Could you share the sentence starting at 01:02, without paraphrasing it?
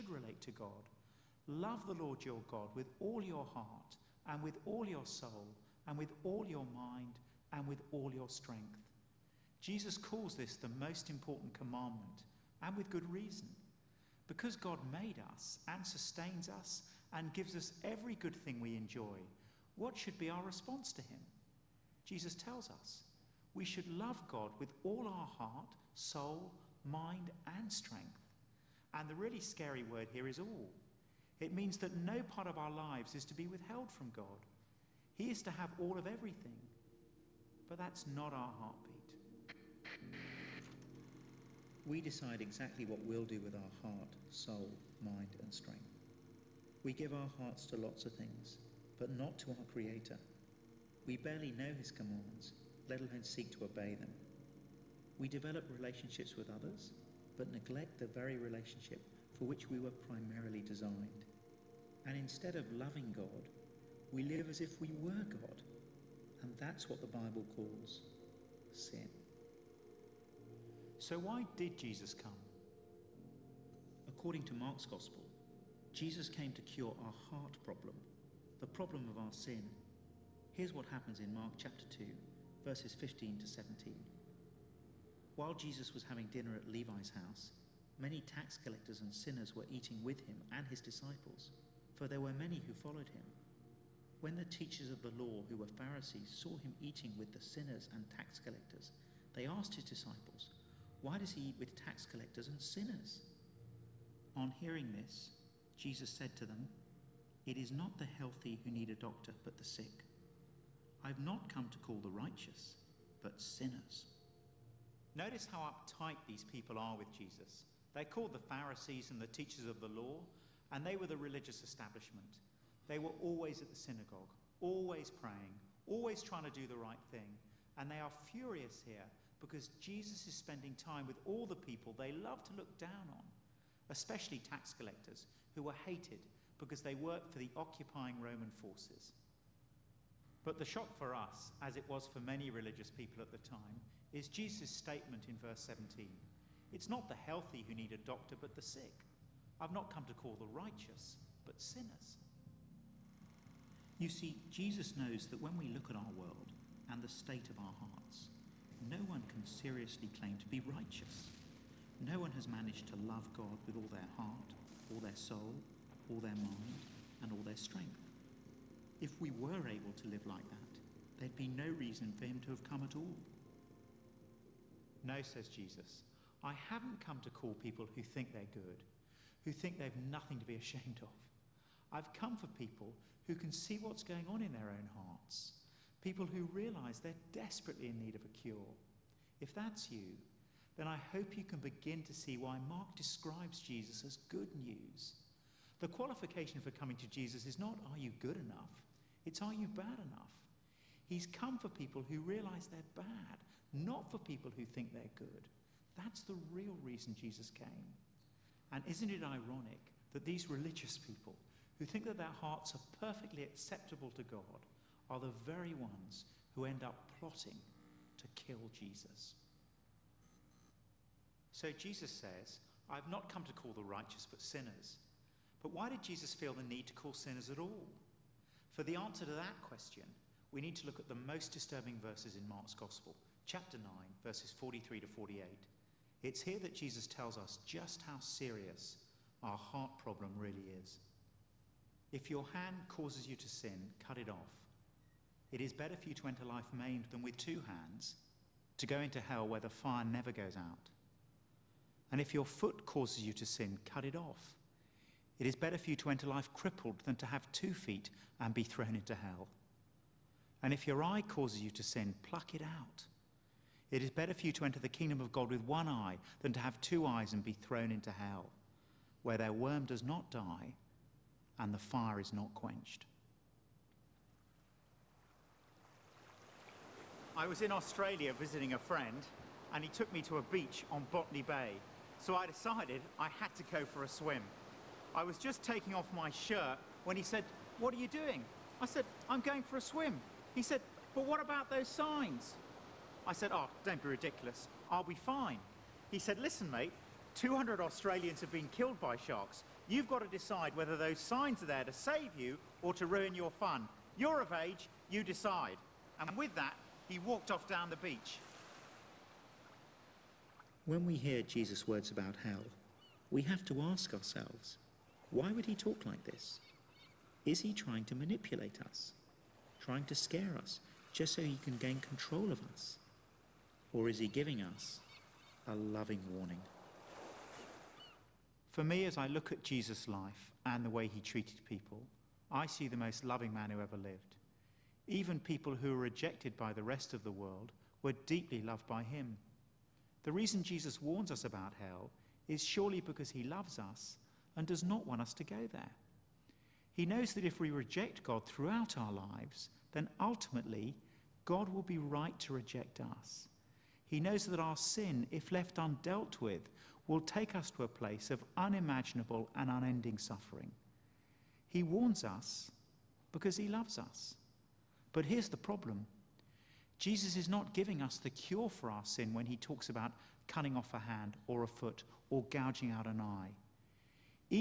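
And instead of loving God, we live as if we were God.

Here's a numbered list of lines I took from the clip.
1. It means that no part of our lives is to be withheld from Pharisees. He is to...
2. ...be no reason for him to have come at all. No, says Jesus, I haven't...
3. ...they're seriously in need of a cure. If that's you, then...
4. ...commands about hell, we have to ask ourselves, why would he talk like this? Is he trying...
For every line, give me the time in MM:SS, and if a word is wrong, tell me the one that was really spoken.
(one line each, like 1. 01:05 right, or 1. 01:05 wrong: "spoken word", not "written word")
1. 00:31 wrong: "God", not "Pharisees"
2. 02:51 right
3. 03:06 wrong: "desperately", not "seriously"
4. 05:11 wrong: "words", not "commands".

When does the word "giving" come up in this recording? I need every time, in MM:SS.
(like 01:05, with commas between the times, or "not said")
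05:24, 06:07.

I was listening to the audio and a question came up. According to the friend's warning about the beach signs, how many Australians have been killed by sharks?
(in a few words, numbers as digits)
200.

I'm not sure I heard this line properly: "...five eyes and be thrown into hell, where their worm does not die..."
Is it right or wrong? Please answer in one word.
wrong.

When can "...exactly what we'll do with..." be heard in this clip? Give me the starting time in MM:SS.
00:42.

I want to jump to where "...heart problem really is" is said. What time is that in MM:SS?
03:59.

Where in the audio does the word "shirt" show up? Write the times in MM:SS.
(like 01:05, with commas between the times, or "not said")
04:46.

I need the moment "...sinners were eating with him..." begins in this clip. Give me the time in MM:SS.
01:29.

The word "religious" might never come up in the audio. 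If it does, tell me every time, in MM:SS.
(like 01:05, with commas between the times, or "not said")
02:01, 02:22, 03:30.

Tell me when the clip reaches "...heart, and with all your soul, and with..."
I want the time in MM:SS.
00:03.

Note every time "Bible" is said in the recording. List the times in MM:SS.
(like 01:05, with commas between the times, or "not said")
01:07.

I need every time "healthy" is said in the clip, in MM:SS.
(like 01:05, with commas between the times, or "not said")
01:48, 02:27.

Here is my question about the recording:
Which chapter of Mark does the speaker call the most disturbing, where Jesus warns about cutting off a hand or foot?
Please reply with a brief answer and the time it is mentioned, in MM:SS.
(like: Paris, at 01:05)
chapter 9, at 03:53.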